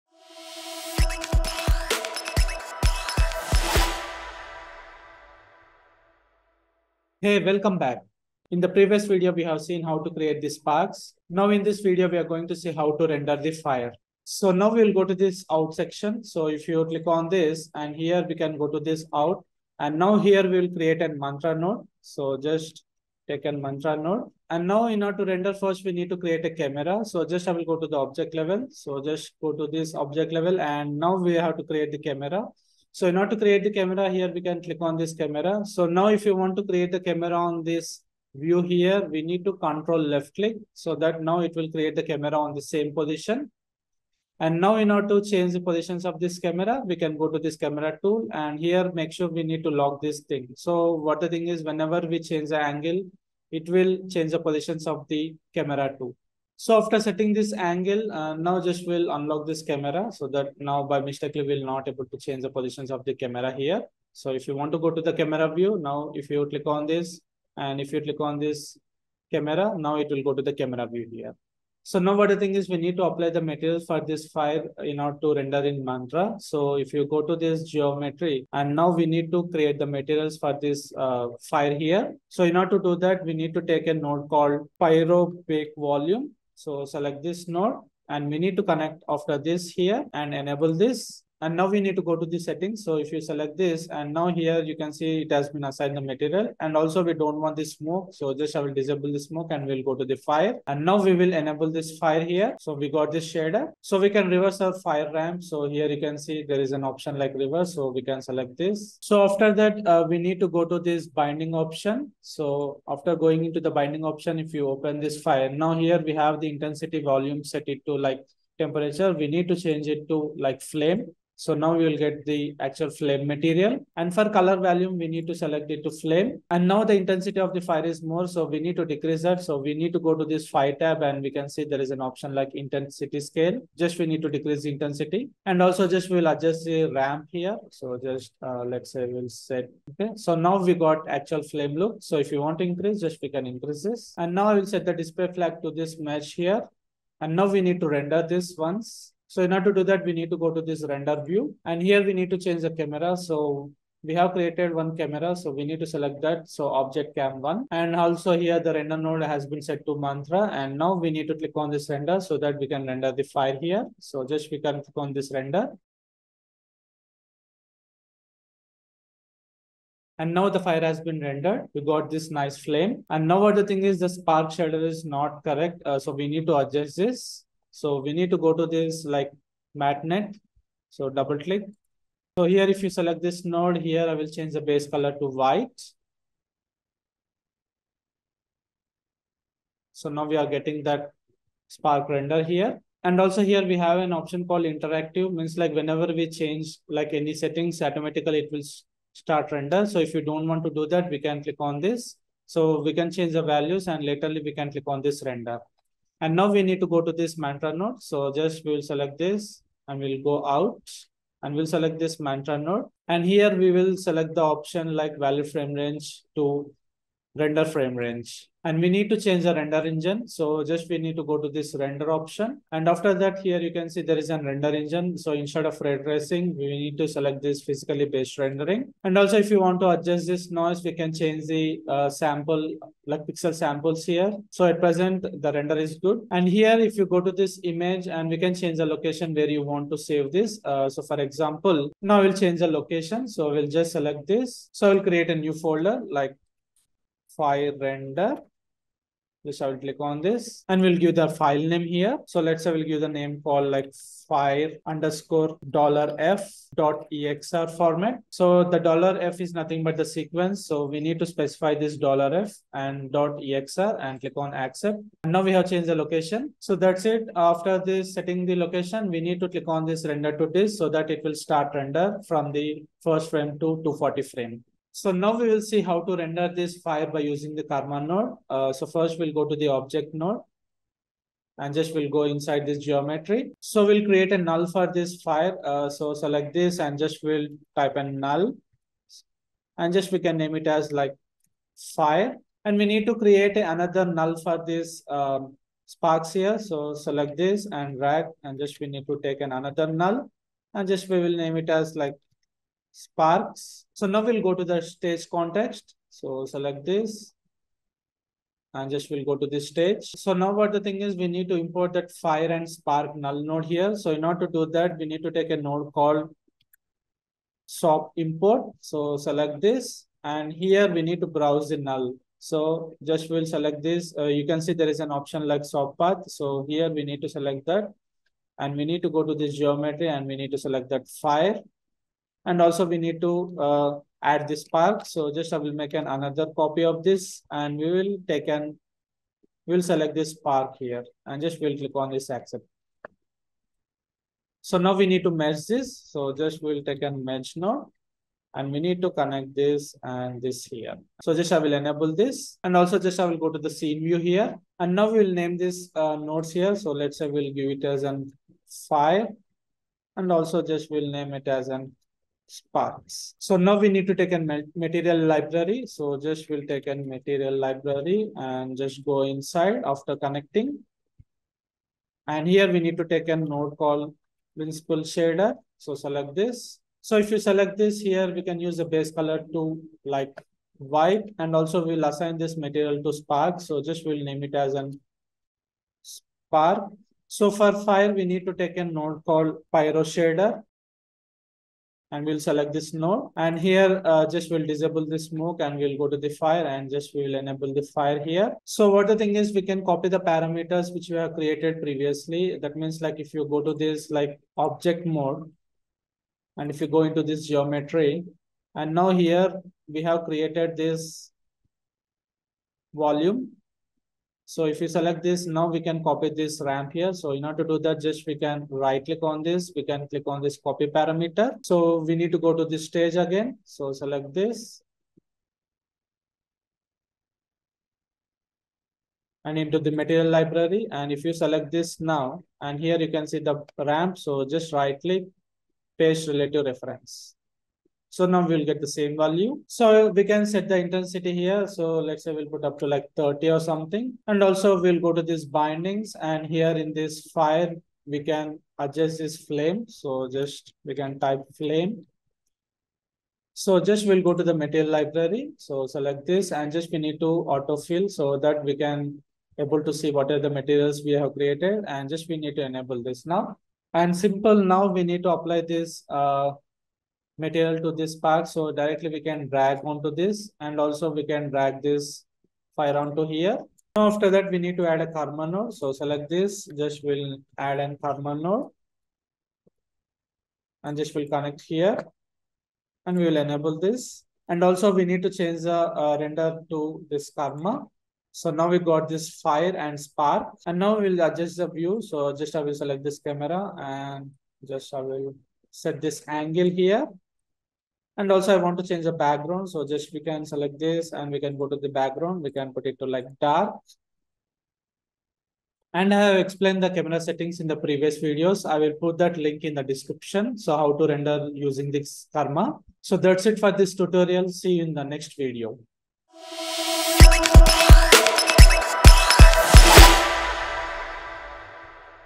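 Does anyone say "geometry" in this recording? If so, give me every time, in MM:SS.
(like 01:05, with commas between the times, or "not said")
01:17, 04:42, 05:29, 06:47.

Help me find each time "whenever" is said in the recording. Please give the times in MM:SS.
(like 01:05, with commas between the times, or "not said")
00:51, 03:15.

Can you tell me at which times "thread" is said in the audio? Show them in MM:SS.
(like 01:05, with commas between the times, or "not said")
not said.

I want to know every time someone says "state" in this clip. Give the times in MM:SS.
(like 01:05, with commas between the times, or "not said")
not said.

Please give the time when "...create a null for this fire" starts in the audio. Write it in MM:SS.
04:44.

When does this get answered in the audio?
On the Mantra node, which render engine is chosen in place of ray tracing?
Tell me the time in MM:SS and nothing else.
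03:47.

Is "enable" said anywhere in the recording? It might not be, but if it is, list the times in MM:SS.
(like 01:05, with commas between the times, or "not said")
01:30, 01:41, 05:51, 06:37, 07:42, 08:03.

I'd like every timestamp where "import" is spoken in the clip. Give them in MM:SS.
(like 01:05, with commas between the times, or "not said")
05:11, 05:18.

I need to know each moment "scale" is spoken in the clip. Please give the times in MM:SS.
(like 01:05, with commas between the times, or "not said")
02:13.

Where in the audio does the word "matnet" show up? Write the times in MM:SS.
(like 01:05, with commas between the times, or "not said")
02:59.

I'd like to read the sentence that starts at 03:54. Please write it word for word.
So at present, the render is good.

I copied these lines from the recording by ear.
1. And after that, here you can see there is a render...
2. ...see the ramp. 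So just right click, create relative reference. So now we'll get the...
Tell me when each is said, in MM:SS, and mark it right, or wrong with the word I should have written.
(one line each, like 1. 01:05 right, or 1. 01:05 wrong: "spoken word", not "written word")
1. 03:42 right
2. 07:13 wrong: "paste", not "create".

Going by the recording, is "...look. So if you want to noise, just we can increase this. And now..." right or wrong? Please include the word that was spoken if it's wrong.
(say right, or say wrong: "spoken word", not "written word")
wrong: "increase", not "noise".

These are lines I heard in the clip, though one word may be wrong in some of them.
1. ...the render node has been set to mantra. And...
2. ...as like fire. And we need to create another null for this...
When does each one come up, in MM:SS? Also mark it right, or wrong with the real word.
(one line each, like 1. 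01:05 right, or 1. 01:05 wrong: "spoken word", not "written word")
1. 02:38 right
2. 04:50 right.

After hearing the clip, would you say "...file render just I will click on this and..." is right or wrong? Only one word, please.
right.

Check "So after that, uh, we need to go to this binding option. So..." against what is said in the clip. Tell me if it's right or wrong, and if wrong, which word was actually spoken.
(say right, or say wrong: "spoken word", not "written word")
right.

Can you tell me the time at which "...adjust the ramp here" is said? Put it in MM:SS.
02:16.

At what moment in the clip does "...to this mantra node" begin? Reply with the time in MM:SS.
03:27.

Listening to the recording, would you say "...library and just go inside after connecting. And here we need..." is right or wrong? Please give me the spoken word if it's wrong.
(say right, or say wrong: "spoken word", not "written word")
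right.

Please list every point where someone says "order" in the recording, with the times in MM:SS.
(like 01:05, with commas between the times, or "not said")
00:25, 00:33, 00:44, 01:14, 01:22, 02:29, 05:14, 06:57.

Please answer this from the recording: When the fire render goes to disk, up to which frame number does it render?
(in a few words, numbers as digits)
240.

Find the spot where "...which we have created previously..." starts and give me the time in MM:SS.
06:40.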